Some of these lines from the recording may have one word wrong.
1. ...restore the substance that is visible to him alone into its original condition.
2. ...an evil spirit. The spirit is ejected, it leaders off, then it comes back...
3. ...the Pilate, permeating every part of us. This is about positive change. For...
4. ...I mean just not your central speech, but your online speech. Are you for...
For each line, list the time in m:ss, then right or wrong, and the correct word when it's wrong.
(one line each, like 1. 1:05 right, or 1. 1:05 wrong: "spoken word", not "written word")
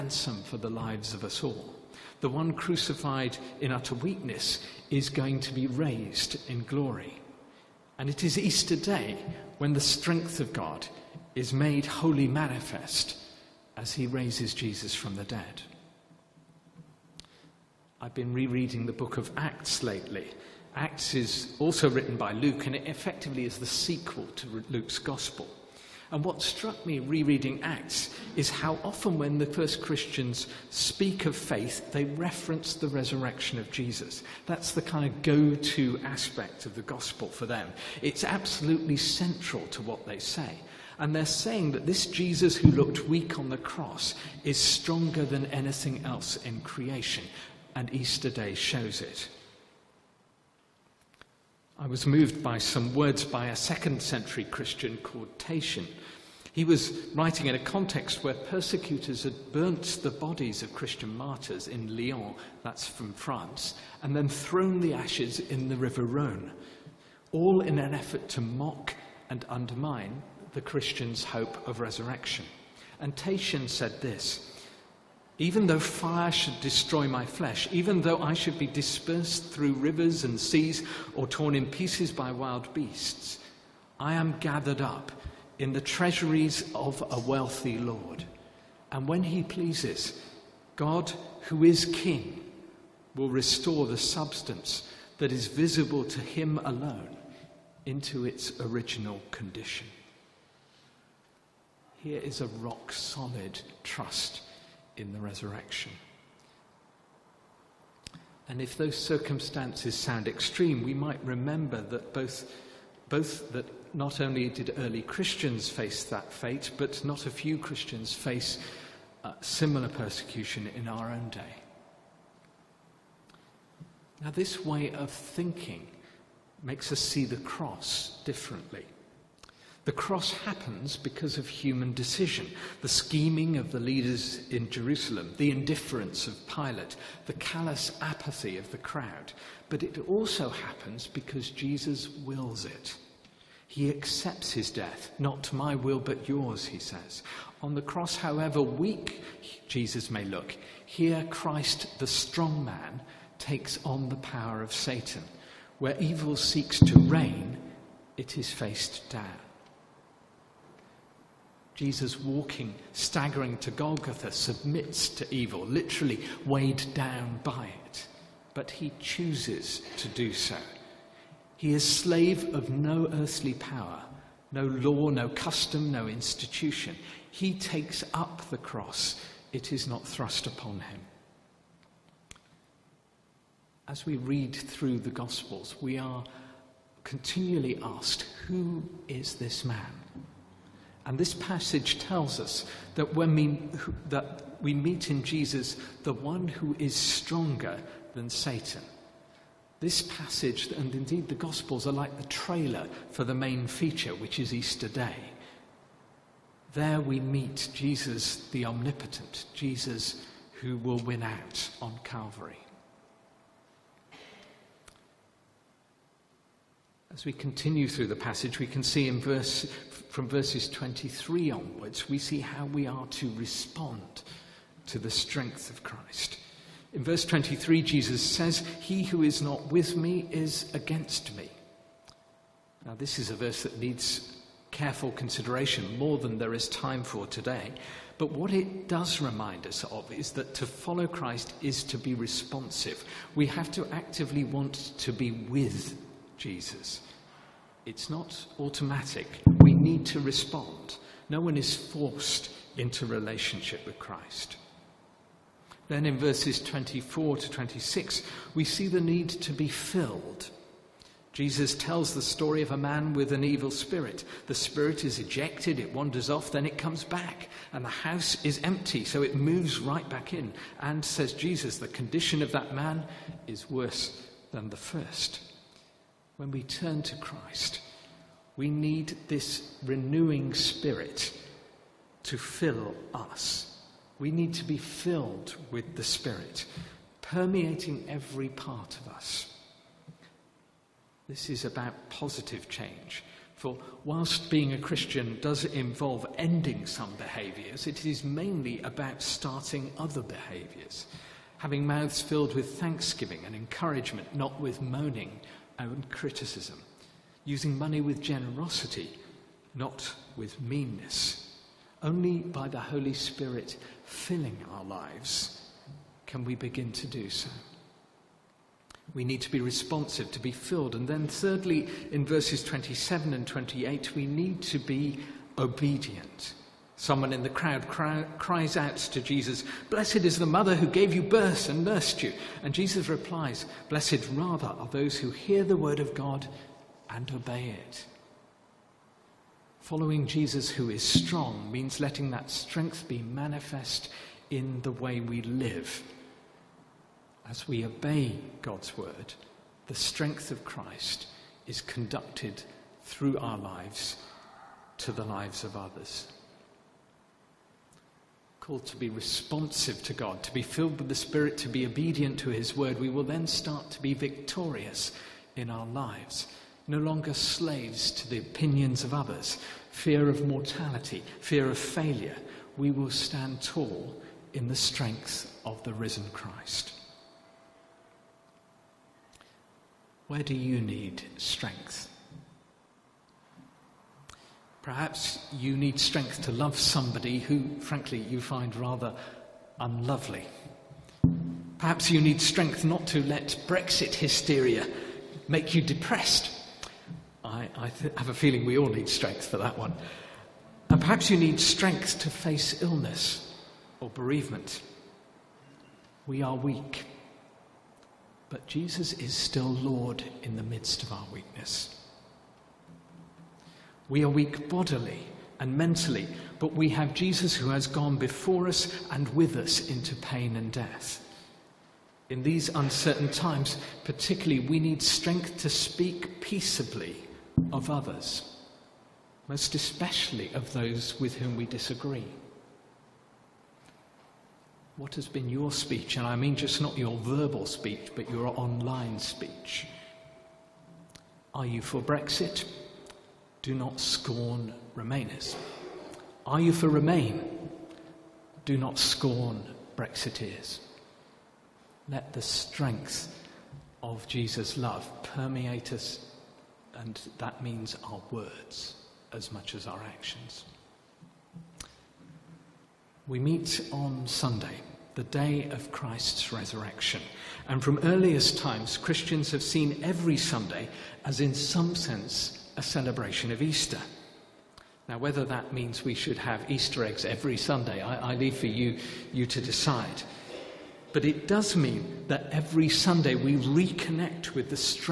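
1. 1:33 right
2. 4:23 wrong: "wanders", not "leaders"
3. 4:45 wrong: "Spirit", not "Pilate"
4. 7:16 wrong: "verbal", not "central".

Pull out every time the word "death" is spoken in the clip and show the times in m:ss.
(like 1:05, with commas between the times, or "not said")
2:24, 7:00.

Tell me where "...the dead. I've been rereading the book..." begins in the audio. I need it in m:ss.
0:15.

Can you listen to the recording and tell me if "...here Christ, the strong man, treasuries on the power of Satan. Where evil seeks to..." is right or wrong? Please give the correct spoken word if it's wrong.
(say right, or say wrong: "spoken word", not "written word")
wrong: "takes", not "treasuries".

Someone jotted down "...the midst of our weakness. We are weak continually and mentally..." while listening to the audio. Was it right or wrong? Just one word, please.
wrong.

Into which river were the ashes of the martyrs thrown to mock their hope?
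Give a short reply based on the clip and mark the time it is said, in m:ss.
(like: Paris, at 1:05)
River Rhone, at 1:05.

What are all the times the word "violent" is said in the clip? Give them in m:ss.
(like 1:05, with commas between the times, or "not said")
not said.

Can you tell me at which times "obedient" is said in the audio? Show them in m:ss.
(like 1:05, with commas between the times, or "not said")
5:25, 6:01.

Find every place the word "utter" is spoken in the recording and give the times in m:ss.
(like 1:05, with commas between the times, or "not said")
0:03.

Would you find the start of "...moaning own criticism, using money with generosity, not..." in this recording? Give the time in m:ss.
5:04.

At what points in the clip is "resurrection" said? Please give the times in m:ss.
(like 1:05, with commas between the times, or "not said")
0:32, 1:11, 1:45, 7:46.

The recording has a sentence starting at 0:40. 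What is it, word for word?
And they're saying that this Jesus who looked weak on the cross is stronger than anything else in creation.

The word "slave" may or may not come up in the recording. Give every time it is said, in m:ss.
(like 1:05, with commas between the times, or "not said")
2:51, 6:07.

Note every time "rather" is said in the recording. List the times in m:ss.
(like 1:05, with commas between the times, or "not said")
5:34, 6:28.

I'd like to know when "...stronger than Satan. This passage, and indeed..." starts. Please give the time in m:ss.
3:16.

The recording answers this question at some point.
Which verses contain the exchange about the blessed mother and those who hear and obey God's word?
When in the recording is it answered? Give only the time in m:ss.
5:22.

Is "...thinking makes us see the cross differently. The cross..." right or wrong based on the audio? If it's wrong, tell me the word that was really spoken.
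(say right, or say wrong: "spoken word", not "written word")
right.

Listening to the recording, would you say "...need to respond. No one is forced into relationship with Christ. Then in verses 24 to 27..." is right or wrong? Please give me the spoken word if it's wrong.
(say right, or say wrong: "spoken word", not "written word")
wrong: "26", not "27".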